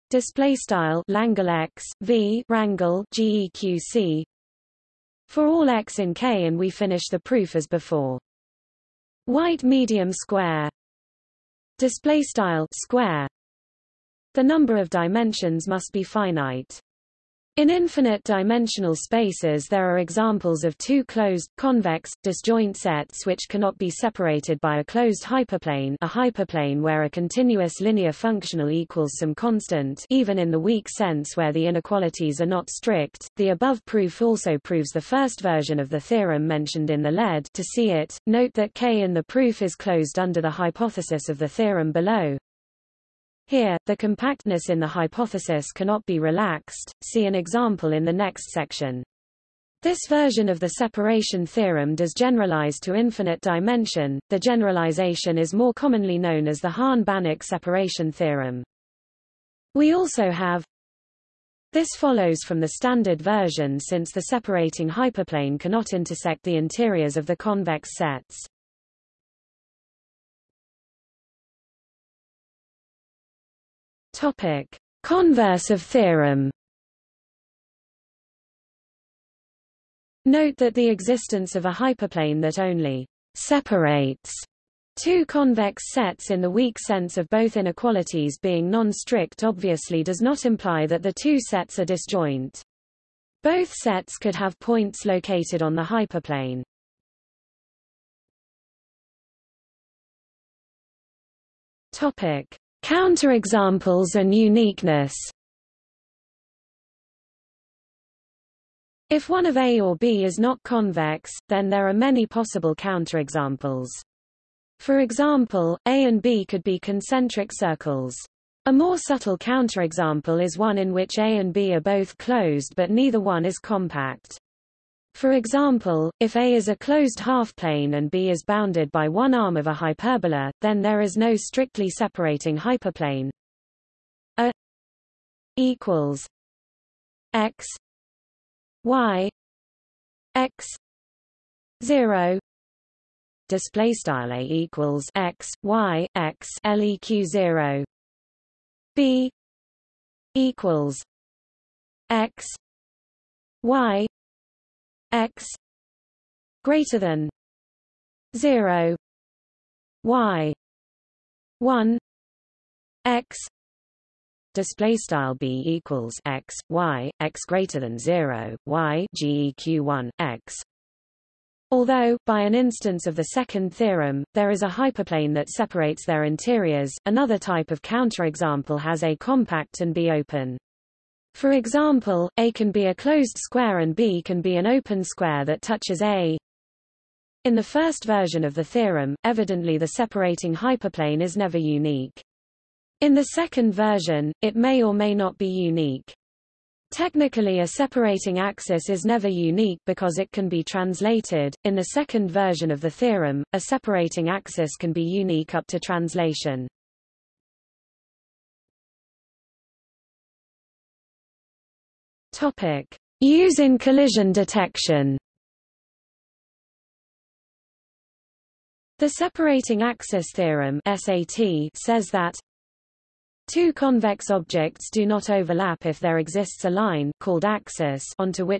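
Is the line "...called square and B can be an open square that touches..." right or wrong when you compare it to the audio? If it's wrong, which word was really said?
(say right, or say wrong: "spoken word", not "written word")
wrong: "closed", not "called".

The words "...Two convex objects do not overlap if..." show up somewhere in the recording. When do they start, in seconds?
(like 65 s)
223 s.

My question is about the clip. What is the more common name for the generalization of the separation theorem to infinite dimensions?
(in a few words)
Hahn-Banach separation theorem.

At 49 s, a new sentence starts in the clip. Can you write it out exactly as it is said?
This version of the separation theorem does generalize to infinite dimension.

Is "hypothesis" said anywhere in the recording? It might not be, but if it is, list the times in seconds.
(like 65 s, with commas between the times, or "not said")
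40 s, 44 s.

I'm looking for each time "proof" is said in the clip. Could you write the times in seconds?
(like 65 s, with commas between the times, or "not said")
7 s, 33 s, 39 s.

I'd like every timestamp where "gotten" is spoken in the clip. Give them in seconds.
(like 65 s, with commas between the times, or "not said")
not said.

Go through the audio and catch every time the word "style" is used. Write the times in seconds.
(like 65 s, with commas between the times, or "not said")
0 s, 12 s, 143 s, 164 s.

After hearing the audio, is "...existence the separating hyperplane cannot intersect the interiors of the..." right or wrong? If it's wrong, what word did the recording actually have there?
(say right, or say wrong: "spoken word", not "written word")
wrong: "since", not "existence".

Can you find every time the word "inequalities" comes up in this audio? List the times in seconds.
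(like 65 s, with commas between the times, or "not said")
31 s, 87 s.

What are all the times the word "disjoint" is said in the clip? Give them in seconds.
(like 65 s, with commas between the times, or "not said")
22 s, 91 s.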